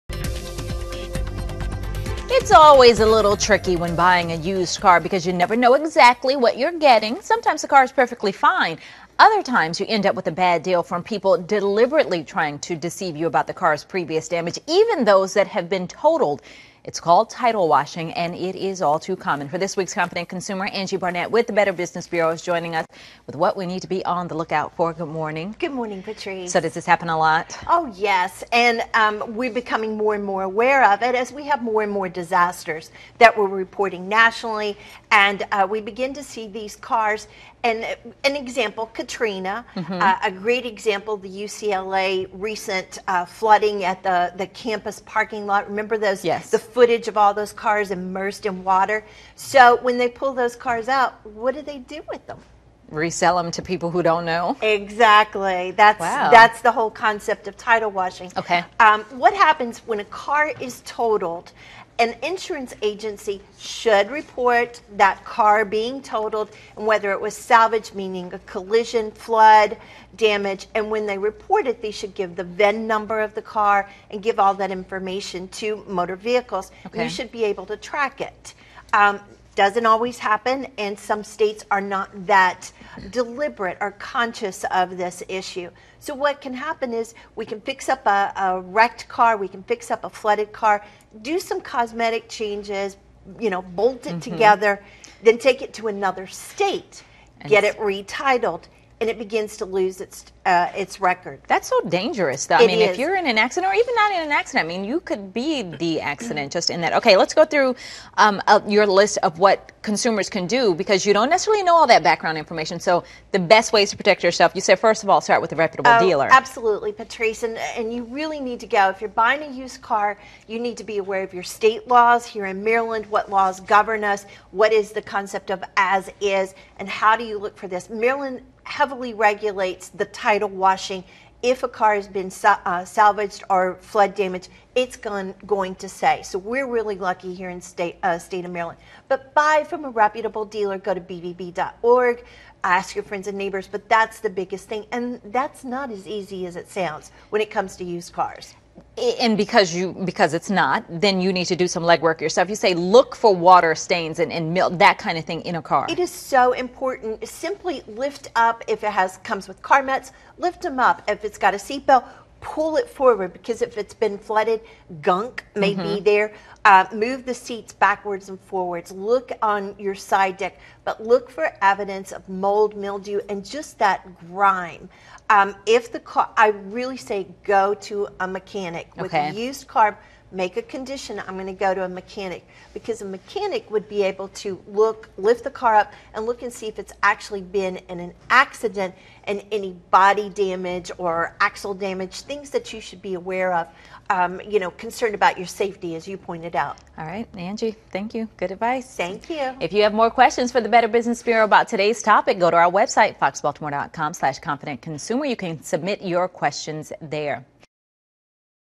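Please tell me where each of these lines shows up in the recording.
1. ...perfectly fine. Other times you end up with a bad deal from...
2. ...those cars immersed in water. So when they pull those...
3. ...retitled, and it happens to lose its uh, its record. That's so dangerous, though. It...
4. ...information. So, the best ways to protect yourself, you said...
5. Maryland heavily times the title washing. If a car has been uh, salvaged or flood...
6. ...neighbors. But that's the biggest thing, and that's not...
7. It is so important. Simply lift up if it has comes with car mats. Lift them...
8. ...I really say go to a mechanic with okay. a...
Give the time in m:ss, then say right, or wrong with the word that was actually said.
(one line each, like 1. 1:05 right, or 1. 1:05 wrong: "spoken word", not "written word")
1. 0:07 right
2. 0:47 right
3. 1:37 wrong: "begins", not "happens"
4. 1:52 right
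5. 2:07 wrong: "regulates", not "times"
6. 2:23 right
7. 2:35 right
8. 2:56 right.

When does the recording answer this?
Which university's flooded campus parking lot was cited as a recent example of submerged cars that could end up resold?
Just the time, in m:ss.
0:41.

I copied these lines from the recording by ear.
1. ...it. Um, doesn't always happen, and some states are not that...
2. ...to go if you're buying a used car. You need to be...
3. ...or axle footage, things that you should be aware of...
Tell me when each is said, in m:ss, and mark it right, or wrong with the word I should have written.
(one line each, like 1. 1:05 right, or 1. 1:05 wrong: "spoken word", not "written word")
1. 1:18 right
2. 1:58 right
3. 3:10 wrong: "damage", not "footage".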